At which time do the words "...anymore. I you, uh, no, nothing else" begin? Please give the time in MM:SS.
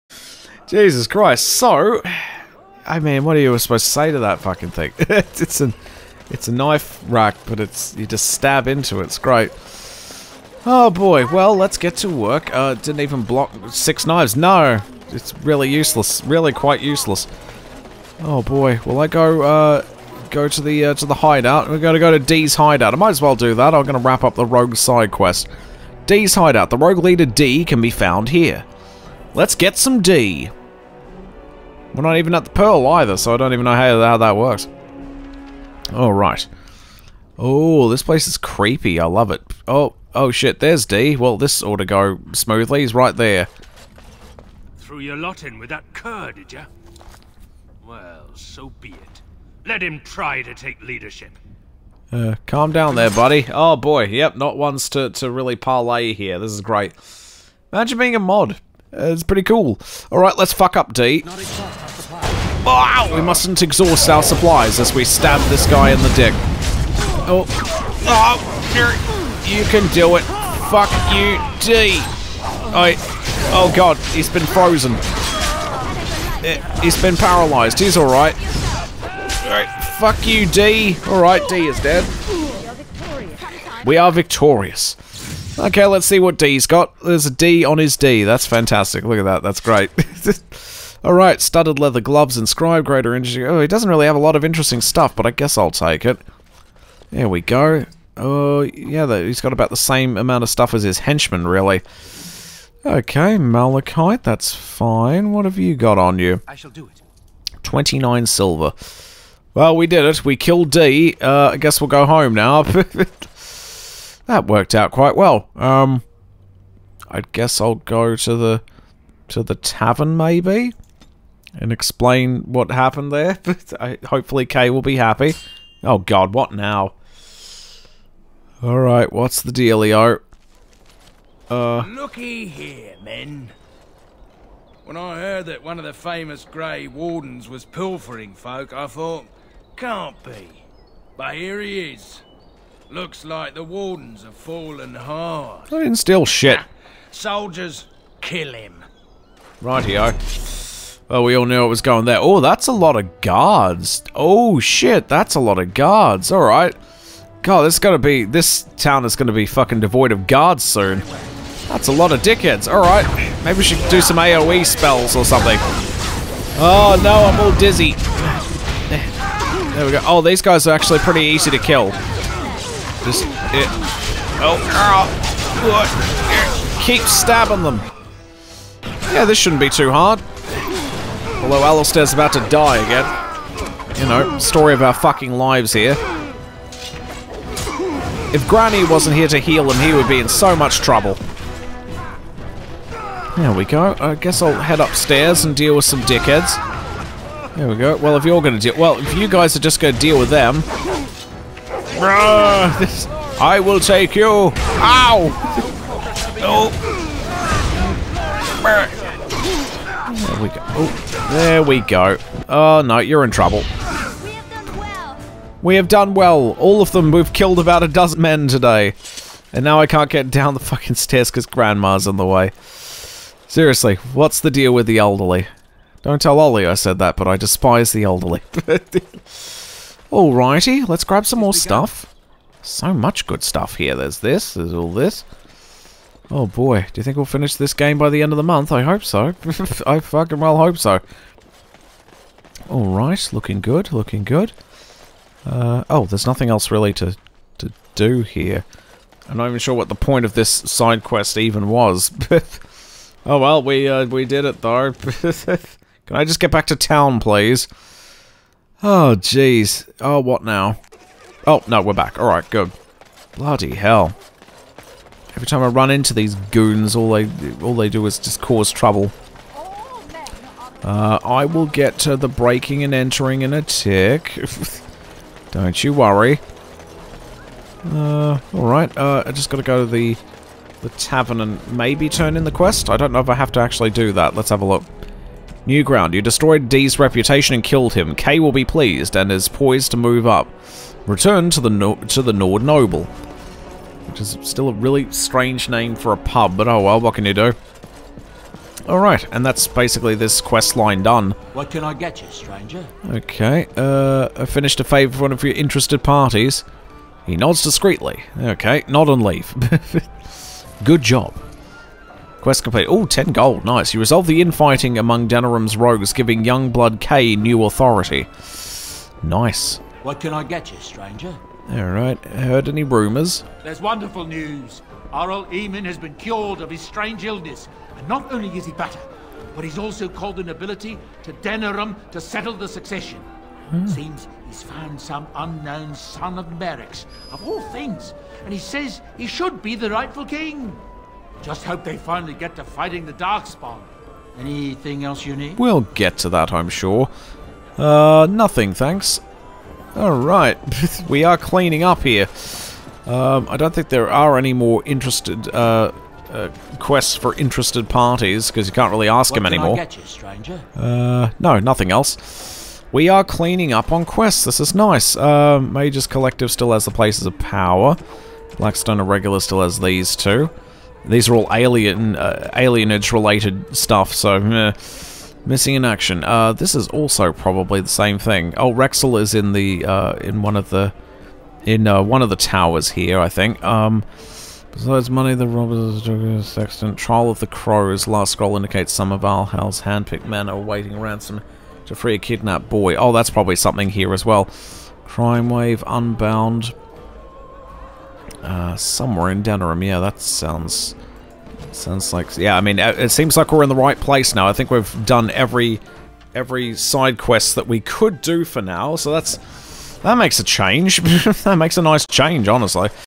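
05:59.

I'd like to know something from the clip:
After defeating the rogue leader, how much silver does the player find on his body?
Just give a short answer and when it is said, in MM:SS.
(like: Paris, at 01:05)
29 silver, at 01:47.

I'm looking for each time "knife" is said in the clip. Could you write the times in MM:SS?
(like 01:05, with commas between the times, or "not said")
00:06.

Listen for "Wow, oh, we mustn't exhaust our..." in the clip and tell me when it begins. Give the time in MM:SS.
01:02.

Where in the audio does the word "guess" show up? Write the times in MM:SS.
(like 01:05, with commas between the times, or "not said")
01:35, 01:51, 01:57, 03:14.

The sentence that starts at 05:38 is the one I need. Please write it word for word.
And he says he should be the rightful king.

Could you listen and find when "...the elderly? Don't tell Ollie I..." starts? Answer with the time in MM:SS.
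03:44.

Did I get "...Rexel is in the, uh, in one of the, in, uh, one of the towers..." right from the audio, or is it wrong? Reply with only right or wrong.
right.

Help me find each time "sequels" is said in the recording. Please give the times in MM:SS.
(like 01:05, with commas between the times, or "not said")
not said.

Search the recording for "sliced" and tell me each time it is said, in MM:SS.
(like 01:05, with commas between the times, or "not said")
not said.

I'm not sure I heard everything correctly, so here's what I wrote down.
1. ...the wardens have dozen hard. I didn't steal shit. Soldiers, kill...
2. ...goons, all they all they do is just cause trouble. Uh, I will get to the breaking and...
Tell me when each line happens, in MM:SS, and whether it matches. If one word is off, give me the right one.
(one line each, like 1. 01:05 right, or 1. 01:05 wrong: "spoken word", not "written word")
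1. 02:23 wrong: "fallen", not "dozen"
2. 04:26 right.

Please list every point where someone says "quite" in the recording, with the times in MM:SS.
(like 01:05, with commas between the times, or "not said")
00:16, 01:54.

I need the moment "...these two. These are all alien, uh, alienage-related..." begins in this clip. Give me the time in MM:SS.
06:09.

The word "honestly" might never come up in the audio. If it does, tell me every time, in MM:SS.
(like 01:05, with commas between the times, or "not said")
06:52.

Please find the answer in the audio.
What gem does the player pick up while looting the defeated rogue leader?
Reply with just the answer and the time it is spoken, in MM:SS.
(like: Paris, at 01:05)
Malachite, at 01:43.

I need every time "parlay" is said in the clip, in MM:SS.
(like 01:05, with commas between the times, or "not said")
00:55.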